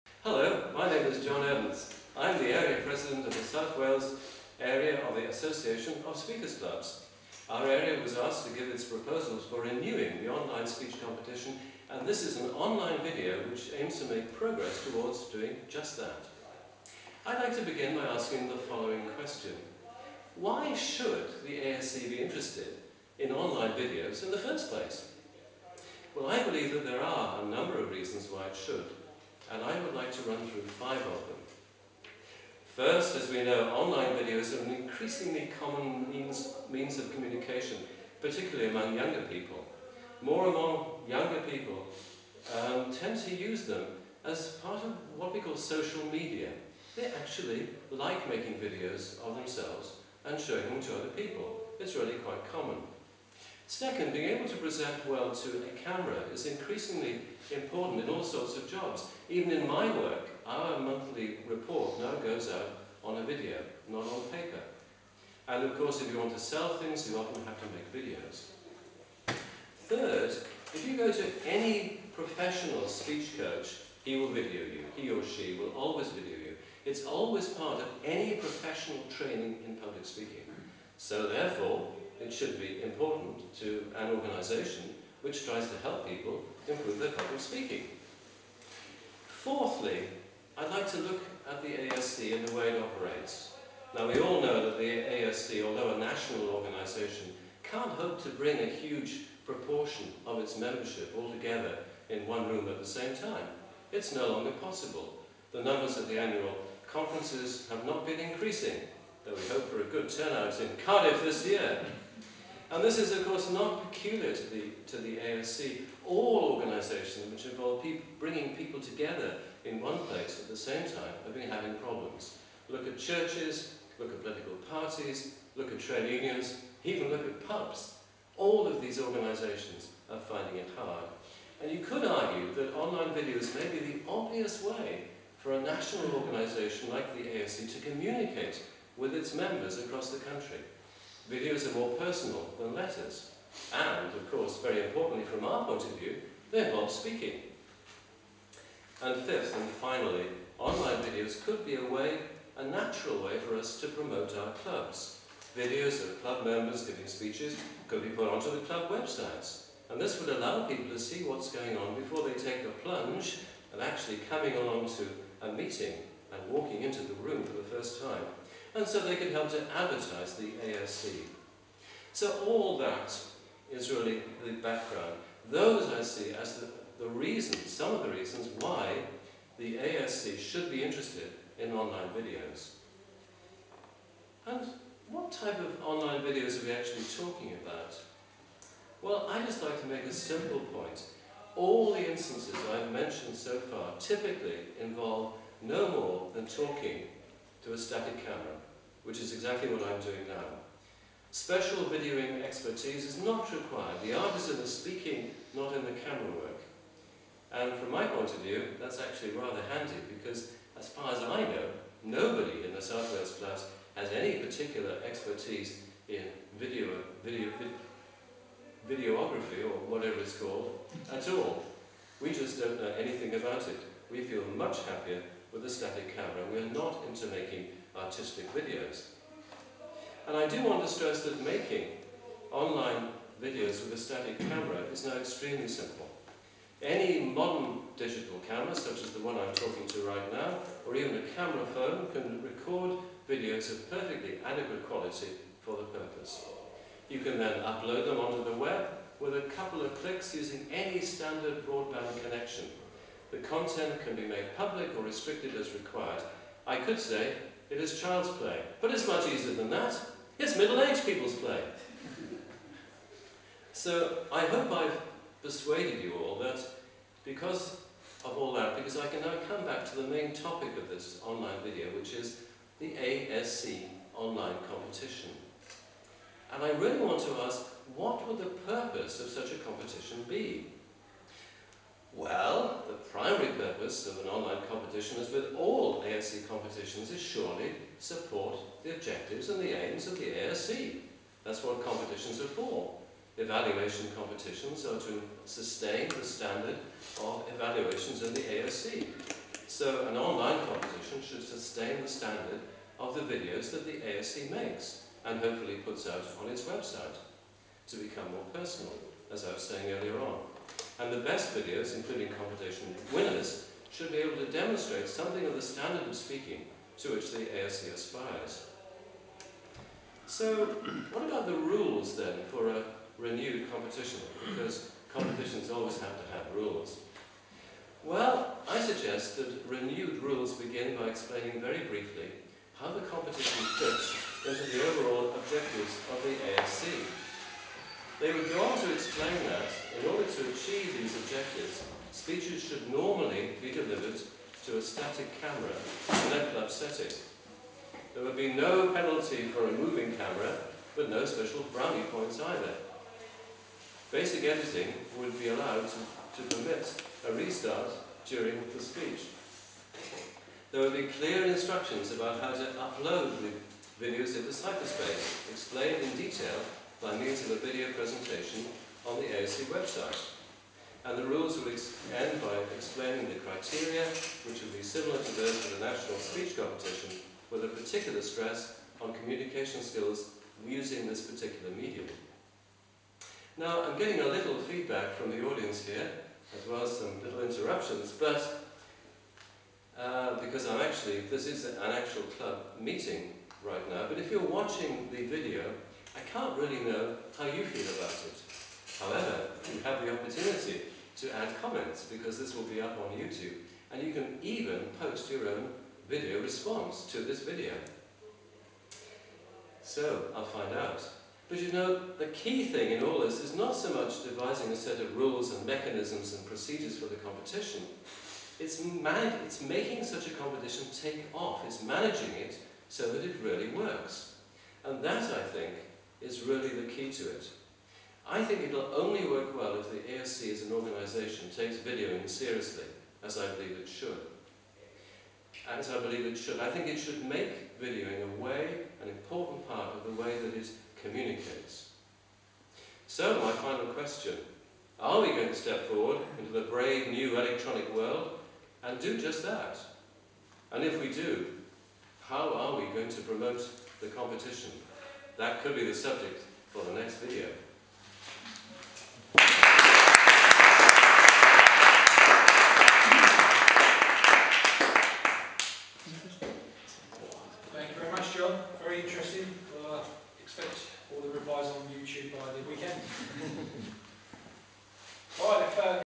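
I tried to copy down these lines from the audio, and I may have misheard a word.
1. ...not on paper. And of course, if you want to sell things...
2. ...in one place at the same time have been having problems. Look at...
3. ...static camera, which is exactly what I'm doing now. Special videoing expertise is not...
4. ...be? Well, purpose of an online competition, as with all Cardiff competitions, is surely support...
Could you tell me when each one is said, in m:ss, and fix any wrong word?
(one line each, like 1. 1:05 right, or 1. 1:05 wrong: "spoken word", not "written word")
1. 1:03 right
2. 1:59 right
3. 3:17 right
4. 4:40 wrong: "ASC", not "Cardiff".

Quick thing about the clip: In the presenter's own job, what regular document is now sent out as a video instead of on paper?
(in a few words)
monthly report.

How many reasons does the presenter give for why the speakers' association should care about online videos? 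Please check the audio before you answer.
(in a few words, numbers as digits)
5.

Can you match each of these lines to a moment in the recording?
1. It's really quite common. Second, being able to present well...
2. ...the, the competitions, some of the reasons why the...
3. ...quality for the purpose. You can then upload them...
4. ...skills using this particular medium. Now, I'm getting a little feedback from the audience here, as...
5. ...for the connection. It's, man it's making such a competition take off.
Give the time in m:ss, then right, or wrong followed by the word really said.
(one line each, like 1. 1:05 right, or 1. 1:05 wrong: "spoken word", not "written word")
1. 0:51 right
2. 2:56 wrong: "reasons", not "competitions"
3. 4:04 right
4. 6:19 right
5. 6:56 wrong: "competition", not "connection".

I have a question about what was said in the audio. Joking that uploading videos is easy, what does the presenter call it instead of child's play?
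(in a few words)
middle-aged people's.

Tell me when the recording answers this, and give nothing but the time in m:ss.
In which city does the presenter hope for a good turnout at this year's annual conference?
1:50.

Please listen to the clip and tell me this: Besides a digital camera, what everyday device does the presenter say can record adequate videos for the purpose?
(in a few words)
camera phone.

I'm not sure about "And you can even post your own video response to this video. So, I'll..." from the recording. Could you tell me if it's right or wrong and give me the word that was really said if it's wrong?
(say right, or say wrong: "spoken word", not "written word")
right.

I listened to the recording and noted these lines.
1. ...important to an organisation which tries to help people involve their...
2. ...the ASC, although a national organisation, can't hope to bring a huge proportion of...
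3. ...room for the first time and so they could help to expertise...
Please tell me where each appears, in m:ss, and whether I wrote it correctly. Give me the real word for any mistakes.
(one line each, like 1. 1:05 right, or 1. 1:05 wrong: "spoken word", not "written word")
1. 1:22 wrong: "improve", not "involve"
2. 1:34 right
3. 2:47 wrong: "advertise", not "expertise".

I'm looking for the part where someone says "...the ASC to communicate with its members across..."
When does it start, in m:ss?
2:17.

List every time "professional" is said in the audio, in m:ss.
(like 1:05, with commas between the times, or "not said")
1:12, 1:18.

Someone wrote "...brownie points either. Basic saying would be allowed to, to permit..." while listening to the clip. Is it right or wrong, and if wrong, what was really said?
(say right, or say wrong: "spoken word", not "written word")
wrong: "editing", not "saying".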